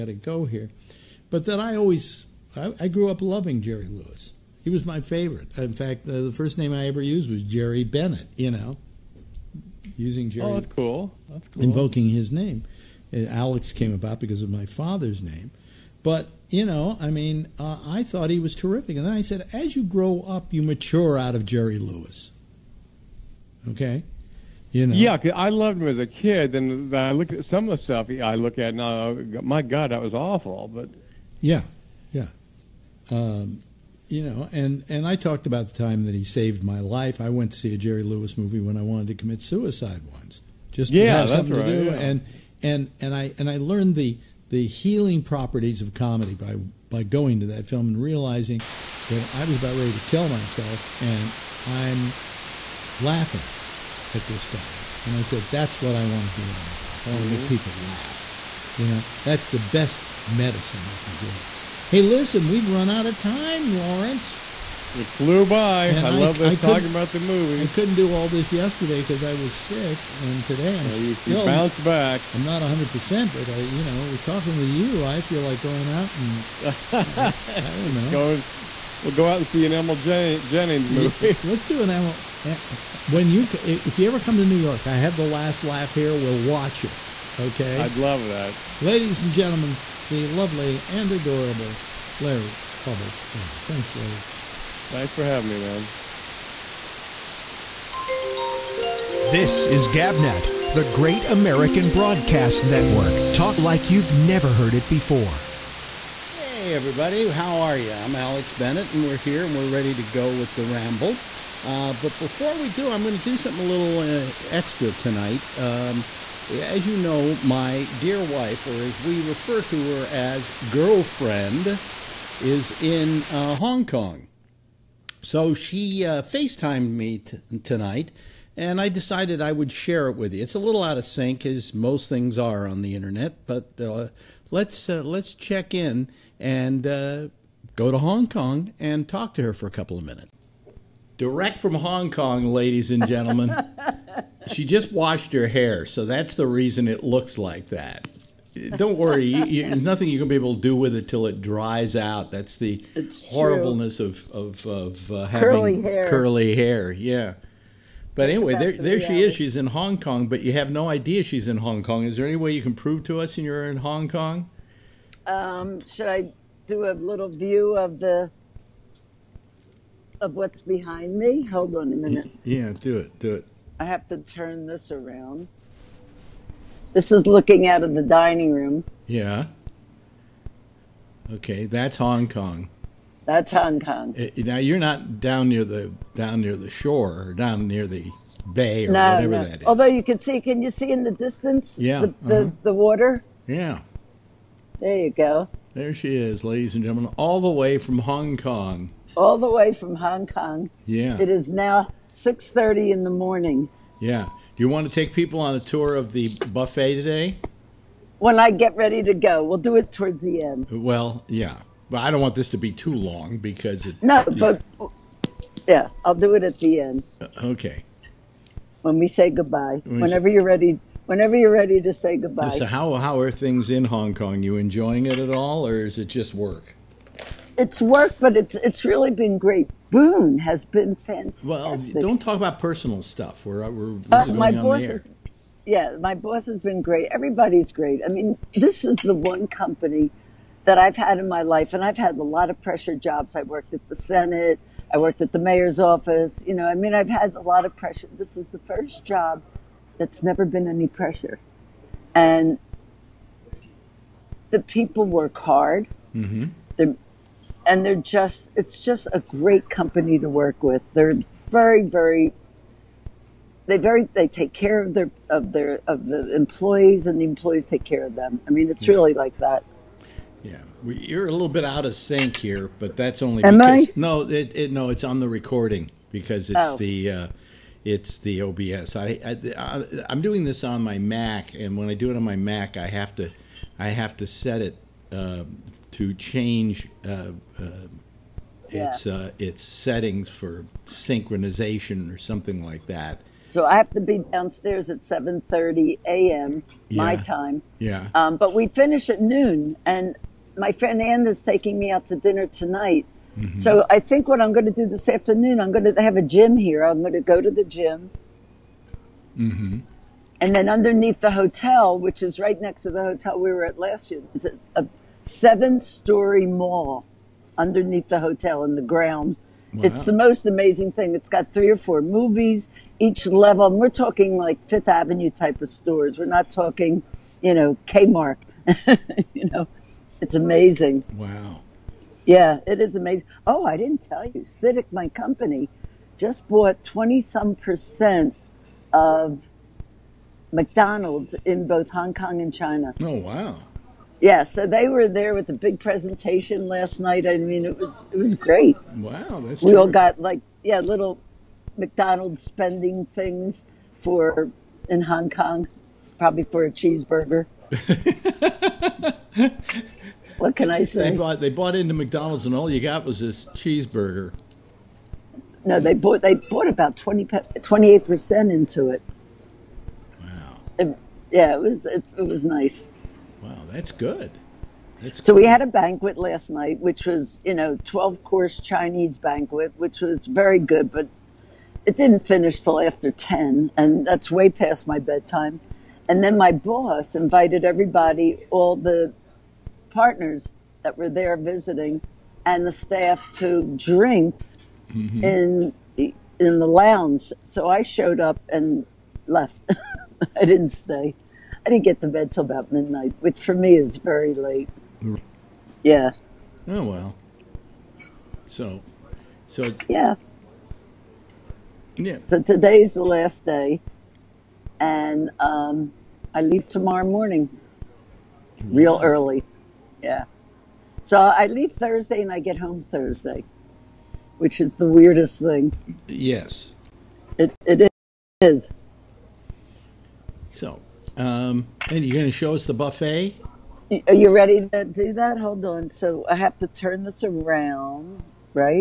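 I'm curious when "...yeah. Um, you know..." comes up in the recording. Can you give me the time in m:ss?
0:32.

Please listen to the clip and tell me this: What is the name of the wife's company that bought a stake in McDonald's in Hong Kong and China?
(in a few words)
Citic.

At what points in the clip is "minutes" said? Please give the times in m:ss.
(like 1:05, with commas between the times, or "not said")
2:20, 2:51.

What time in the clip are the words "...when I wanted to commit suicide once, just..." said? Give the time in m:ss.
0:38.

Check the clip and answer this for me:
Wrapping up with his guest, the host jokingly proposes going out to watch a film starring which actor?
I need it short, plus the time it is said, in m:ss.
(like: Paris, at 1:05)
Emil Jannings, at 1:19.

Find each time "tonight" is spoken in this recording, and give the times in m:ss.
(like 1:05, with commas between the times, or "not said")
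1:54, 2:07, 5:02.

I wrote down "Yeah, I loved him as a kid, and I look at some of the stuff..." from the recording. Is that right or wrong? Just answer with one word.
right.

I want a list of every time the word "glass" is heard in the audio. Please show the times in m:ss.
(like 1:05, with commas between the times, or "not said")
not said.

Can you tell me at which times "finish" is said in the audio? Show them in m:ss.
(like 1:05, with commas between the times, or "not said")
4:58, 6:22.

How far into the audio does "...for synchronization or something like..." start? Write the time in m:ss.
4:50.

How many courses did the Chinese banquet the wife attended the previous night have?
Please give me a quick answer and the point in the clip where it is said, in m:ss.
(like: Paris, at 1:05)
12, at 6:17.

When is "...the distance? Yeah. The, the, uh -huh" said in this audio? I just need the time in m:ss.
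3:11.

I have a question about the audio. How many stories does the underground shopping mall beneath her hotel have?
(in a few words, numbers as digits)
7.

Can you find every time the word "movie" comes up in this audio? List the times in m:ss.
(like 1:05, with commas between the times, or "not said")
0:38, 1:07, 1:20, 5:22.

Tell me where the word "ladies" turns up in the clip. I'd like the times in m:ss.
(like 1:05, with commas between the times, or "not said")
1:28, 2:22, 3:16.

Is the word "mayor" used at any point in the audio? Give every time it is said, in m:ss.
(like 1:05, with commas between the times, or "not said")
4:05.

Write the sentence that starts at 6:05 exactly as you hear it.
No, they bought they bought about 28 percent into it.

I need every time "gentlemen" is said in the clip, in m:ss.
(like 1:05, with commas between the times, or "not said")
1:29, 2:23, 3:16.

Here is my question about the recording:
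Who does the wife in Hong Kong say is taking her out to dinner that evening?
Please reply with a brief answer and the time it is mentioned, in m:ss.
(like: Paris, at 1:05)
Anne, at 5:00.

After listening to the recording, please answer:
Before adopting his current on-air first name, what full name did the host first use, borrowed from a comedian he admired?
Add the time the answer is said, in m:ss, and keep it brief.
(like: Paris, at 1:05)
Jerry Bennett, at 0:07.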